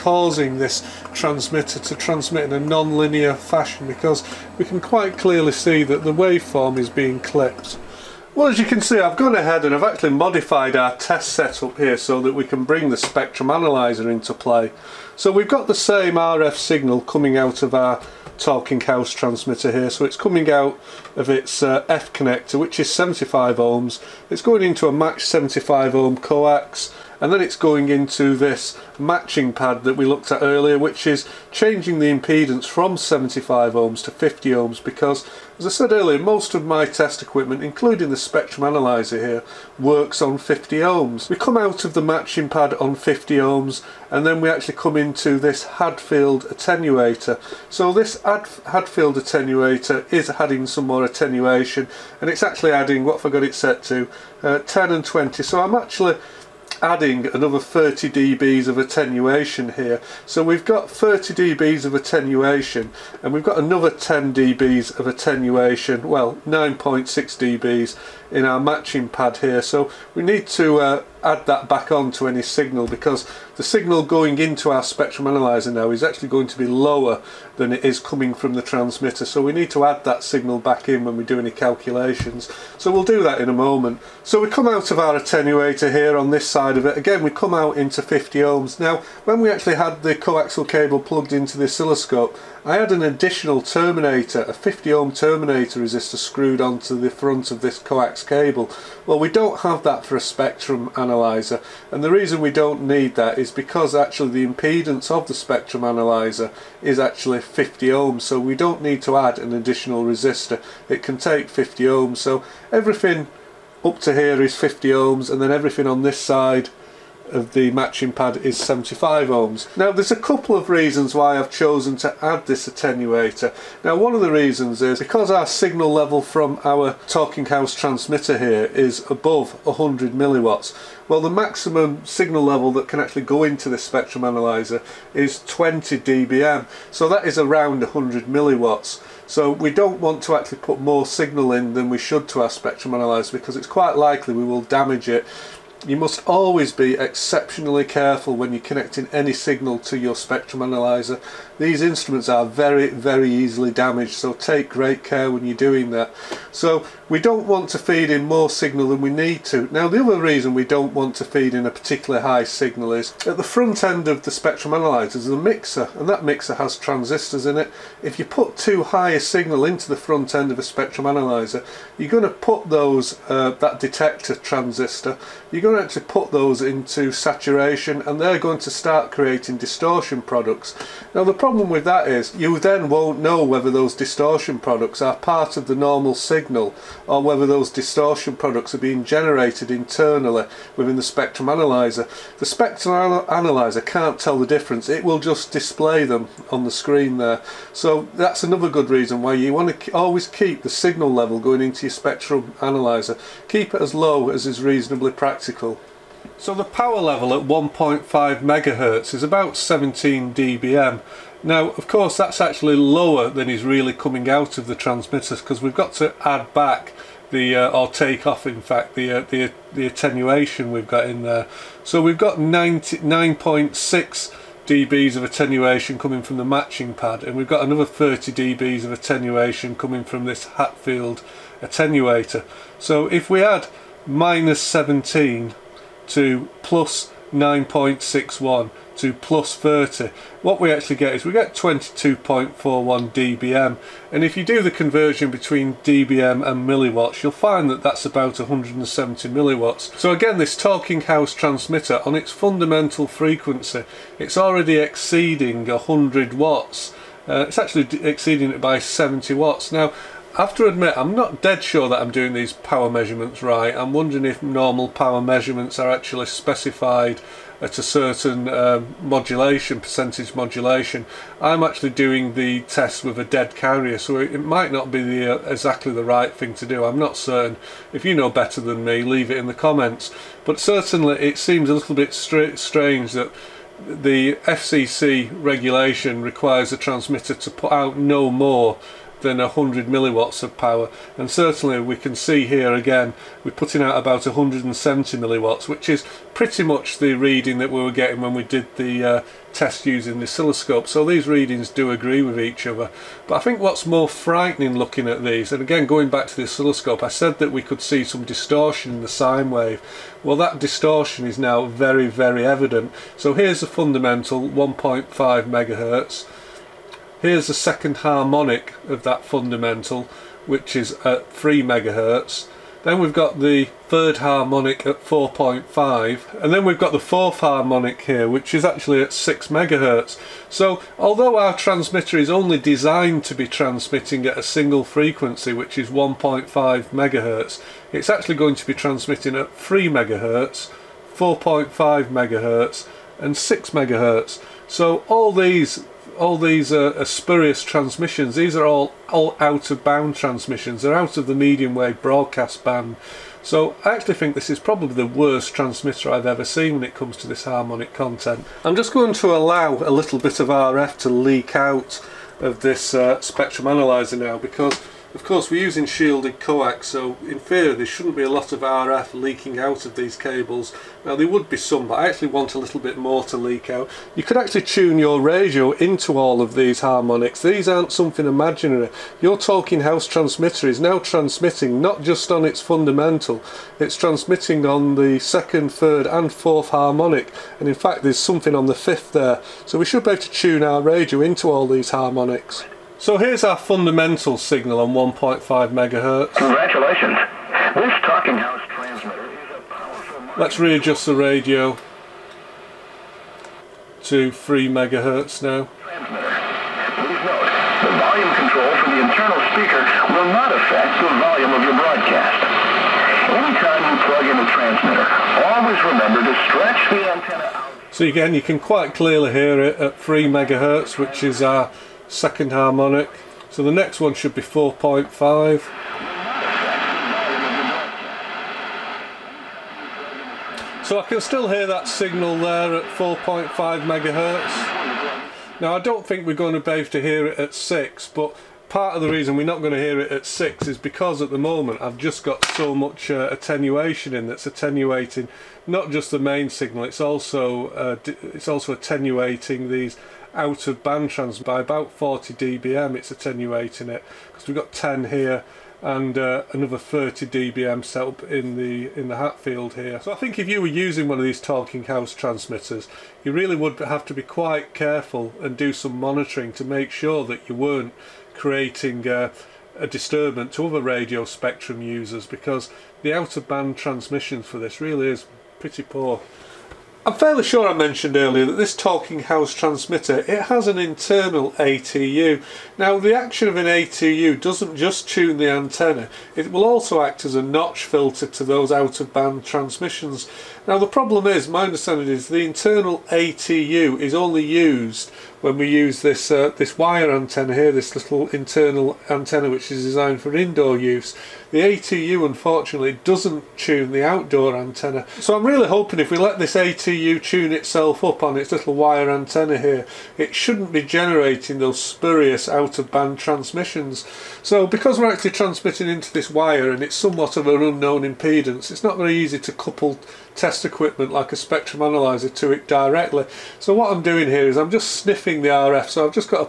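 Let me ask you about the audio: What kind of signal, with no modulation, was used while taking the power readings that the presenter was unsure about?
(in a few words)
a dead carrier.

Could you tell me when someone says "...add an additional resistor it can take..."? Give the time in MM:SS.
01:49.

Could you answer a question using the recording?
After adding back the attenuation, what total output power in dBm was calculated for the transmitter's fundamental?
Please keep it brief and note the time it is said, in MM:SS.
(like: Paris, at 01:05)
22.41 dBm, at 04:01.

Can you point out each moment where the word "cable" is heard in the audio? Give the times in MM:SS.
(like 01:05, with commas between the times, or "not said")
01:30, 01:38, 06:10.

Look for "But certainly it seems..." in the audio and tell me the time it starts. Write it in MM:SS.
04:40.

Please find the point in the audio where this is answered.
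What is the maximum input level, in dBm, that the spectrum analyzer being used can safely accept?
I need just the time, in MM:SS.
02:15.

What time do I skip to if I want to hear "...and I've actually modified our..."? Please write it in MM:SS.
00:09.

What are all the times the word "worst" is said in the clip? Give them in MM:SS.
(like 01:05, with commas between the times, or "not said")
05:55.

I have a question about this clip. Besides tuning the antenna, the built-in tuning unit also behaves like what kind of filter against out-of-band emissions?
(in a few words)
a notch filter.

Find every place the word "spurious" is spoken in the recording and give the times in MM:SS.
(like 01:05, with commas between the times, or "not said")
05:47, 08:31.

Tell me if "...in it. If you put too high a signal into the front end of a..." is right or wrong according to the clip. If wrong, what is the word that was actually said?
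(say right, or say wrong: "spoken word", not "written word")
right.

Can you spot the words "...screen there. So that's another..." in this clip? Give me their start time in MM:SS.
03:16.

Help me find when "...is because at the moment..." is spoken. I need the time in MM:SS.
07:20.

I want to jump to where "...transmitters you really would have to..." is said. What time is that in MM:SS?
07:42.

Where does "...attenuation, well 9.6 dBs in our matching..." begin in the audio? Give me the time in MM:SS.
01:05.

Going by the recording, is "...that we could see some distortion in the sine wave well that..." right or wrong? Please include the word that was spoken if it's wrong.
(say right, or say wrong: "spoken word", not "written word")
right.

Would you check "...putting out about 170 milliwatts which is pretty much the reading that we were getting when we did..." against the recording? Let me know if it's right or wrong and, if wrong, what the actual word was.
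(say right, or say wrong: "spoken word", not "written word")
right.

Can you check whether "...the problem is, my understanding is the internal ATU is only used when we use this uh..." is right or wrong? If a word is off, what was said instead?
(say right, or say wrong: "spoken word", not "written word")
right.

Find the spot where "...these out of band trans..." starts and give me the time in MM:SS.
07:29.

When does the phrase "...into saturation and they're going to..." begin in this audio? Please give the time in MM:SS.
02:56.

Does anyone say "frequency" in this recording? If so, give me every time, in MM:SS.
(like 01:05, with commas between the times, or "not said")
04:13, 05:34.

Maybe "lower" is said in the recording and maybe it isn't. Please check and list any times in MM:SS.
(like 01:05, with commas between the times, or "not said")
01:16, 03:32.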